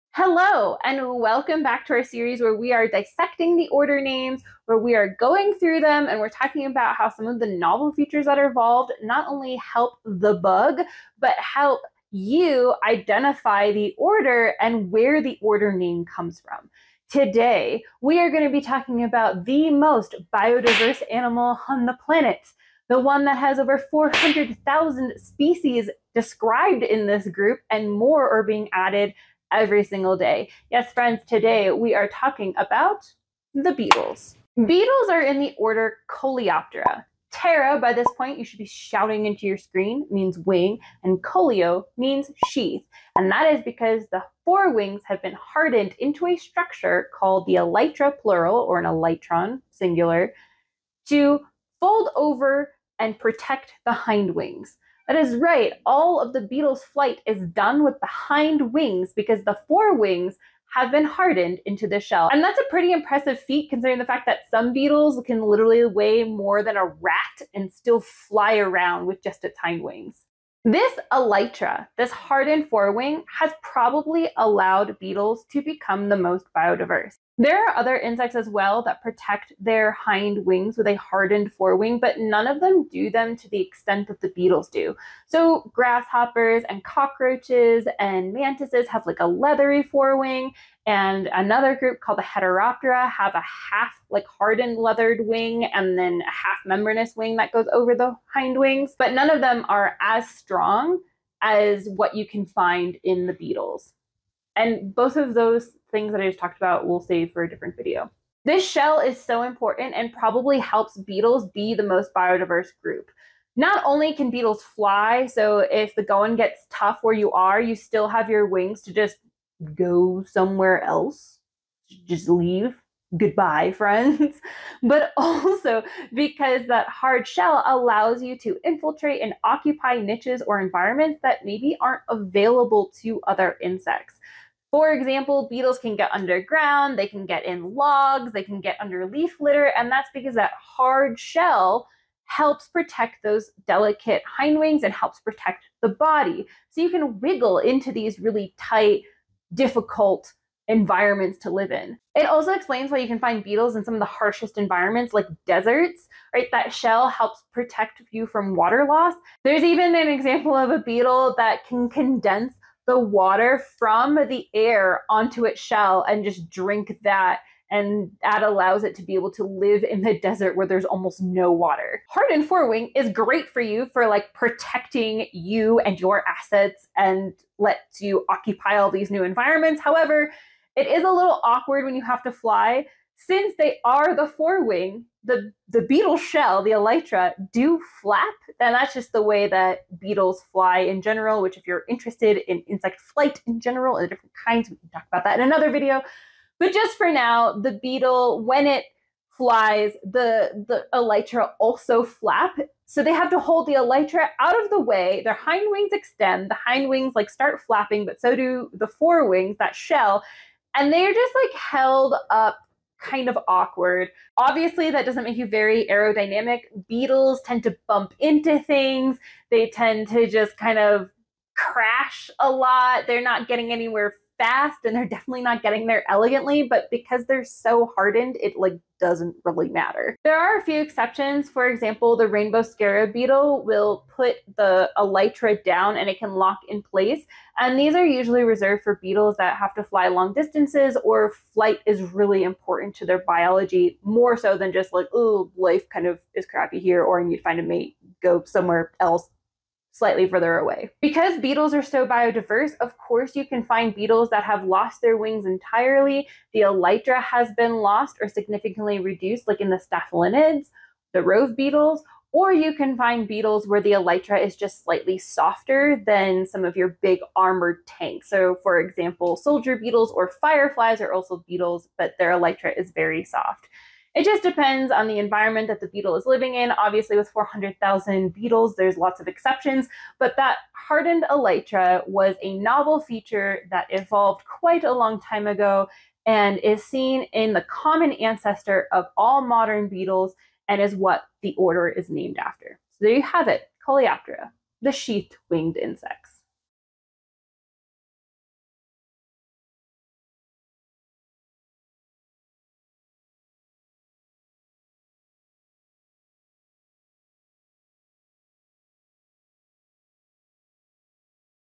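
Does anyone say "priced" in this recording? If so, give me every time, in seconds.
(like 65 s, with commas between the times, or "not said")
not said.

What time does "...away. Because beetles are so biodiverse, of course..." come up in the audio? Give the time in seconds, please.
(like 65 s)
250 s.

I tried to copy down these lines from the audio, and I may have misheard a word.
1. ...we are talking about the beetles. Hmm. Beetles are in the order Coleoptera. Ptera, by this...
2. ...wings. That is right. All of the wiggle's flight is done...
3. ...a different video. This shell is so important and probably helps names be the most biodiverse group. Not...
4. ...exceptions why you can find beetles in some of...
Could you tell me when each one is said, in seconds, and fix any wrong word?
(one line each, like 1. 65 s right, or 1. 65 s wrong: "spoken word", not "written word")
1. 31 s right
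2. 54 s wrong: "beetle", not "wiggle"
3. 107 s wrong: "beetles", not "names"
4. 152 s wrong: "explains", not "exceptions".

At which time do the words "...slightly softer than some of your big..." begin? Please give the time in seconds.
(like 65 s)
264 s.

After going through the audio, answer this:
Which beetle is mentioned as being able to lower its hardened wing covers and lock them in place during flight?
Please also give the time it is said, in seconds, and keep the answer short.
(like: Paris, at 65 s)
rainbow scarab beetle, at 232 s.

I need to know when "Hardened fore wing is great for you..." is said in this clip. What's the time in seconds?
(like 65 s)
172 s.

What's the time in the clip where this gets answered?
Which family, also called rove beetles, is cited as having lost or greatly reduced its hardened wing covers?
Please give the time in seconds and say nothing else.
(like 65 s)
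259 s.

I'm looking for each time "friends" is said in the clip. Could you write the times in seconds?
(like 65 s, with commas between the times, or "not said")
30 s, 123 s.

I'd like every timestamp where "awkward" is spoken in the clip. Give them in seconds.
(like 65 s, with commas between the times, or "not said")
181 s, 213 s.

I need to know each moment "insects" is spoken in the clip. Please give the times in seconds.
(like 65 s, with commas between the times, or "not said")
77 s, 133 s, 192 s, 295 s.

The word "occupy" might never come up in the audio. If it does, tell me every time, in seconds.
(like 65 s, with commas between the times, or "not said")
129 s, 178 s.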